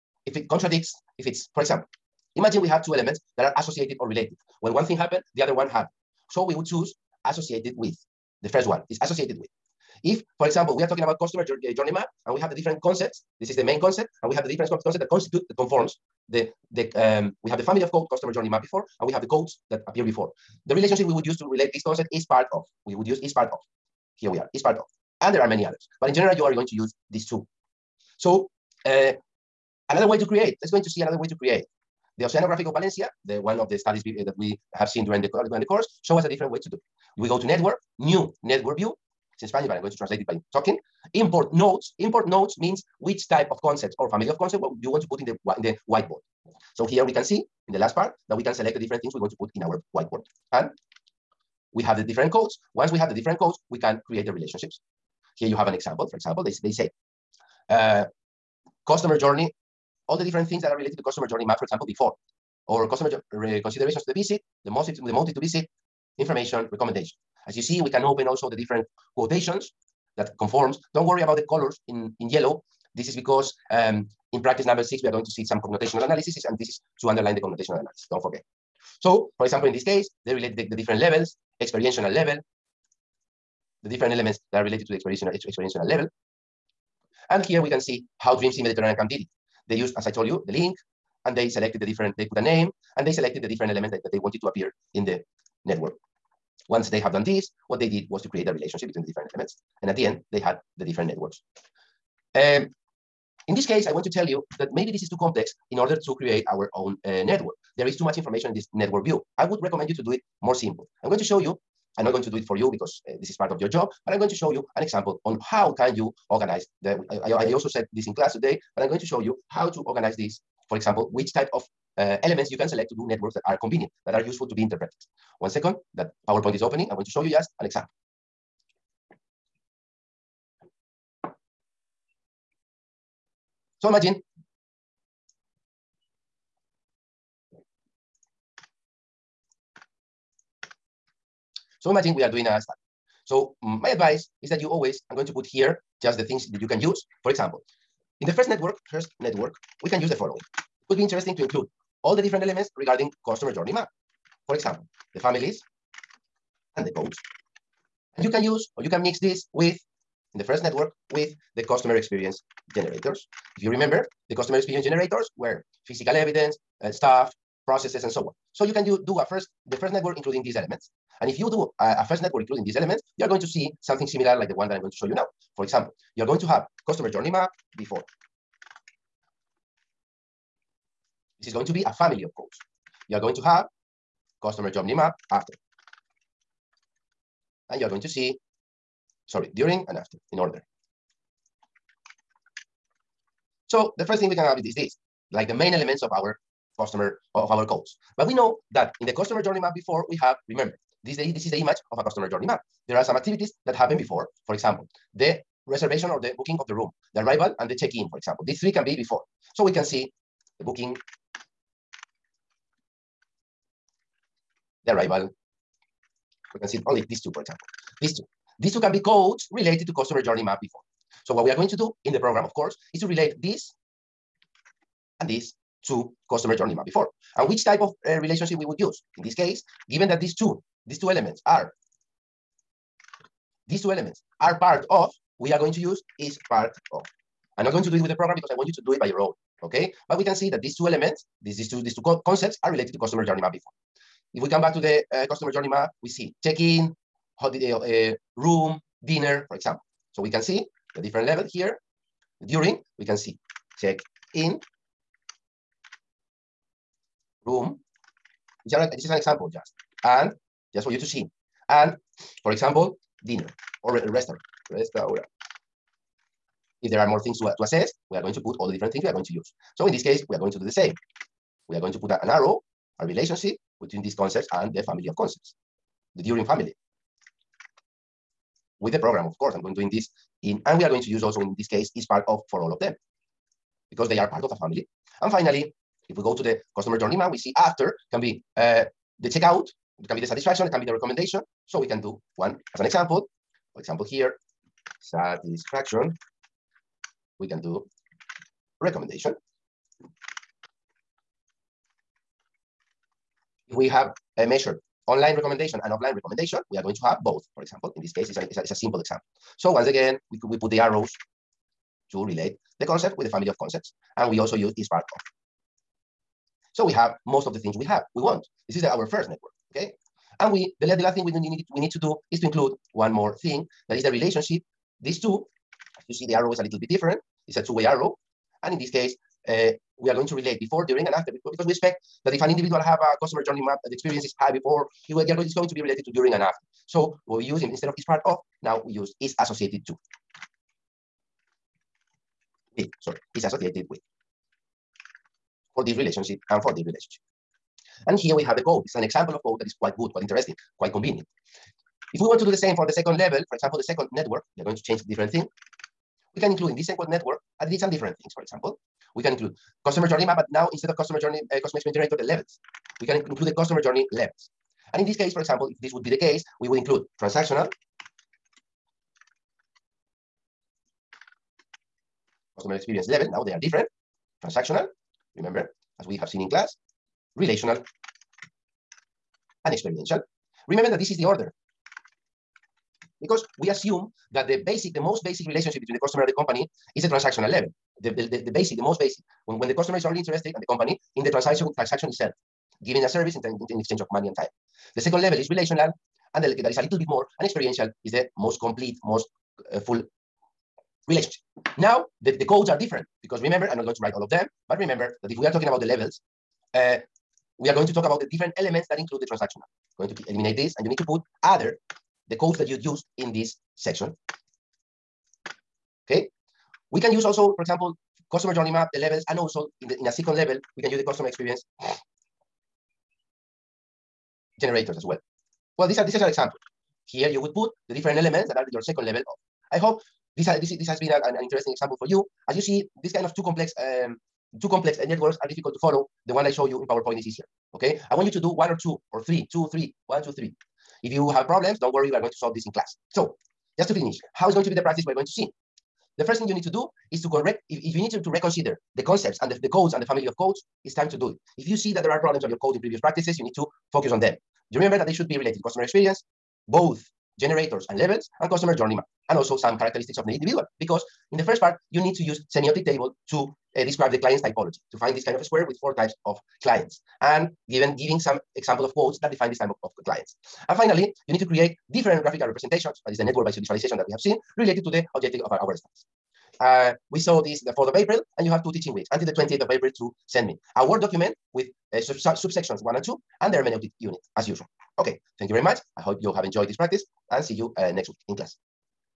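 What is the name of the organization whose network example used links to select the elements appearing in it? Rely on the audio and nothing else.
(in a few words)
Dream Sea Mediterranean Camp.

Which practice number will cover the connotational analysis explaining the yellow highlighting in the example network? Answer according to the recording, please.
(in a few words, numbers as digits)
6.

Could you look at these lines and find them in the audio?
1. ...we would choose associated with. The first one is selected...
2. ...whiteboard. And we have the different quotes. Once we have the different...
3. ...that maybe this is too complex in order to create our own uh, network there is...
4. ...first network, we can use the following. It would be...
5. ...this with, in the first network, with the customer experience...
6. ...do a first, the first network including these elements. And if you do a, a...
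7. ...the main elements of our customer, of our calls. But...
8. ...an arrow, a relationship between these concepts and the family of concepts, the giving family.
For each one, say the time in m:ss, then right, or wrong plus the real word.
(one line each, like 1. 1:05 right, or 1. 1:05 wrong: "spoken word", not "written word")
1. 0:06 wrong: "associated", not "selected"
2. 0:49 wrong: "codes", not "quotes"
3. 1:44 right
4. 2:28 right
5. 2:39 right
6. 2:49 right
7. 3:15 right
8. 4:32 wrong: "during", not "giving".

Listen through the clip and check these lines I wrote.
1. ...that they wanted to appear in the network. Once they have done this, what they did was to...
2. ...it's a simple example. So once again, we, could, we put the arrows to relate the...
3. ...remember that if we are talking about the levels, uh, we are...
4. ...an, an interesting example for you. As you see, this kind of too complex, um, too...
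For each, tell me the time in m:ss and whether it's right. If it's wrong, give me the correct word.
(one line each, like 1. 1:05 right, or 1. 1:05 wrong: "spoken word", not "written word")
1. 1:34 right
2. 5:08 right
3. 6:44 right
4. 7:11 right.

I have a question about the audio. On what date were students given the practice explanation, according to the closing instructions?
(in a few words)
4th of April.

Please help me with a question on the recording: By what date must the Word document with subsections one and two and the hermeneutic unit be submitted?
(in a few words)
28th of April.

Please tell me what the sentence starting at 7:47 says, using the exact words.
And given, giving some example of quotes that define this type of, of clients.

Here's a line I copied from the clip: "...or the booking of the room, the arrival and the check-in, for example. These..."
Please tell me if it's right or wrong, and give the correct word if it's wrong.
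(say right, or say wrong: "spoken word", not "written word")
right.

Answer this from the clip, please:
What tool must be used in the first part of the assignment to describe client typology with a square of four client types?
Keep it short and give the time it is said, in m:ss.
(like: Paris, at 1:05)
semiotic table, at 7:42.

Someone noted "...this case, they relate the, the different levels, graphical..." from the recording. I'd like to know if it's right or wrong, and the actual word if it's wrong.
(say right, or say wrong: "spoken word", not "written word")
wrong: "experiential", not "graphical".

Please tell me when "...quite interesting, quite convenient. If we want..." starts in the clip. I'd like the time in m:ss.
5:50.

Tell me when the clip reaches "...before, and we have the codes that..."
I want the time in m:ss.
0:18.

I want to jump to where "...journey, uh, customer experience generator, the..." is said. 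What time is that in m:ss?
6:01.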